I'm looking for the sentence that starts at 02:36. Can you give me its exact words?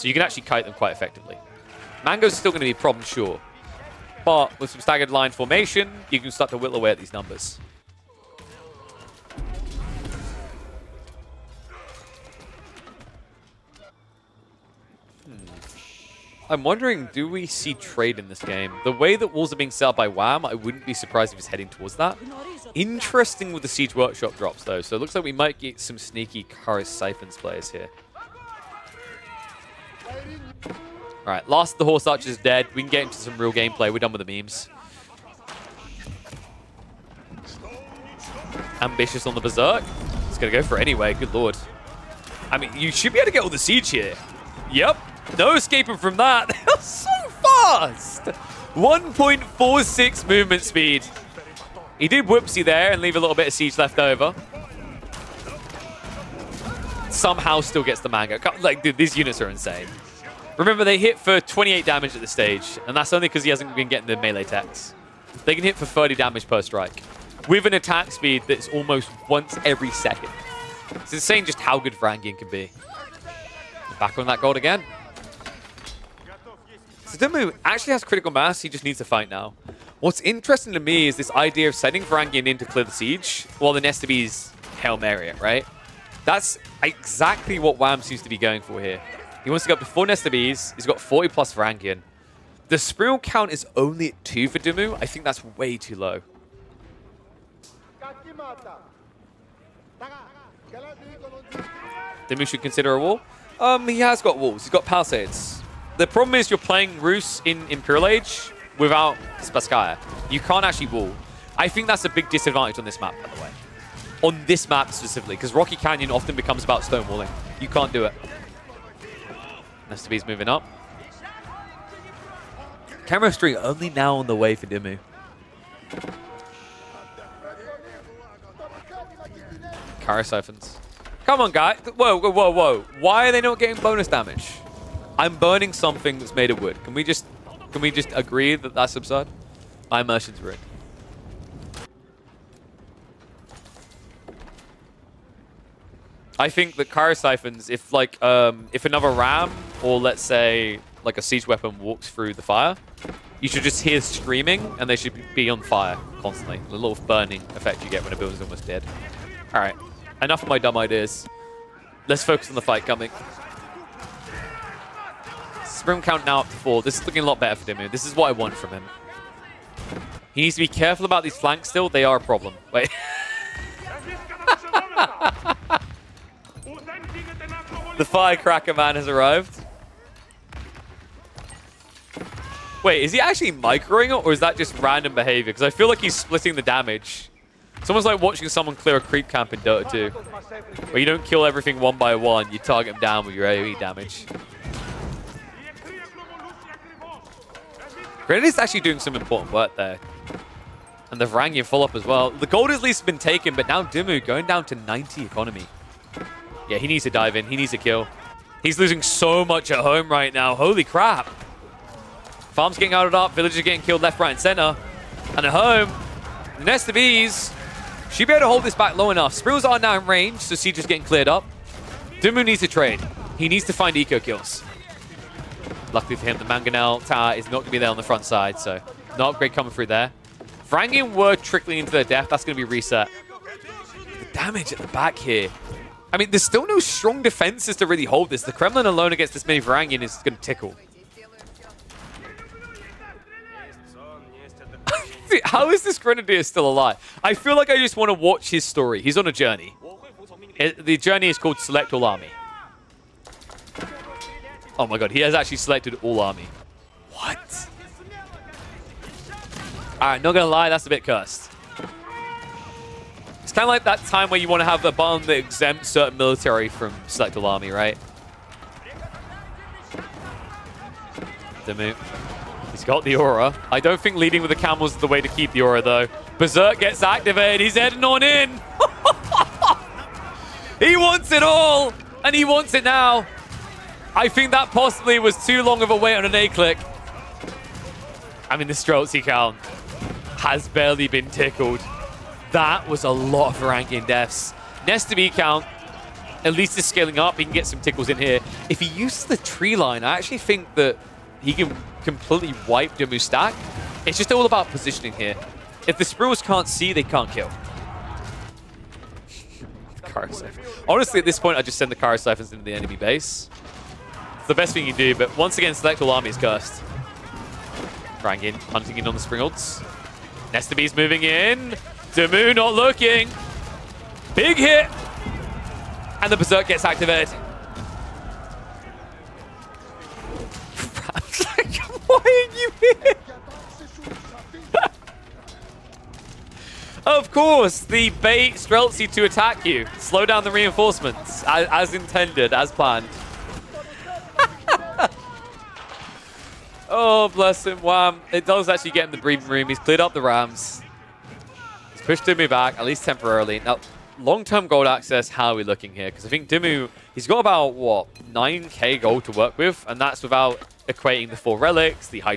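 The little burning effect you get when a building's almost dead.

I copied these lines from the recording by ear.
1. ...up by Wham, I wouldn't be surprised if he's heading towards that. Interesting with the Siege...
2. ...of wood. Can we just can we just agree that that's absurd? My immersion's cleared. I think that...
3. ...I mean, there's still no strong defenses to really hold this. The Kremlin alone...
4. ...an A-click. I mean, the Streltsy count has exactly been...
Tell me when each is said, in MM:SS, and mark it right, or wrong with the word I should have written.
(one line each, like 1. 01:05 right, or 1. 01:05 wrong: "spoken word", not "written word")
1. 00:19 right
2. 02:16 wrong: "rigged", not "cleared"
3. 03:56 right
4. 04:46 wrong: "barely", not "exactly".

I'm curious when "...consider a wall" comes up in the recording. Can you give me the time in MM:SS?
01:42.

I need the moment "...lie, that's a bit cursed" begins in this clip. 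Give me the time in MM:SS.
04:20.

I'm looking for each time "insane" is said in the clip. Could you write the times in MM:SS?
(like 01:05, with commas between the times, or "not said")
00:59, 01:11.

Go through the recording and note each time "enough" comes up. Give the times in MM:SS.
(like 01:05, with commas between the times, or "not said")
02:40, 03:39.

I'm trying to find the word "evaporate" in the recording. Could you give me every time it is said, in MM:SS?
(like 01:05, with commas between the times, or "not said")
not said.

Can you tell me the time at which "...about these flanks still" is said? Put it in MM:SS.
02:51.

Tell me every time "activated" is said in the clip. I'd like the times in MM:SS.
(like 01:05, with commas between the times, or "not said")
04:37, 05:26.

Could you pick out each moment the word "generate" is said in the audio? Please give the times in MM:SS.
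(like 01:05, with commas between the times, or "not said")
not said.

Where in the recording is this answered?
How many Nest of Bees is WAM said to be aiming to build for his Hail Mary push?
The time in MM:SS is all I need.
01:29.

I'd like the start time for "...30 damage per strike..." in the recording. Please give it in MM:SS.
01:05.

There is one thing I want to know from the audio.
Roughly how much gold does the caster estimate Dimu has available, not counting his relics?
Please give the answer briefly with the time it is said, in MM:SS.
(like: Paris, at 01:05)
9k, at 05:58.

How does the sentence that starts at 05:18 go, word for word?
Crying hunting in on the springalds.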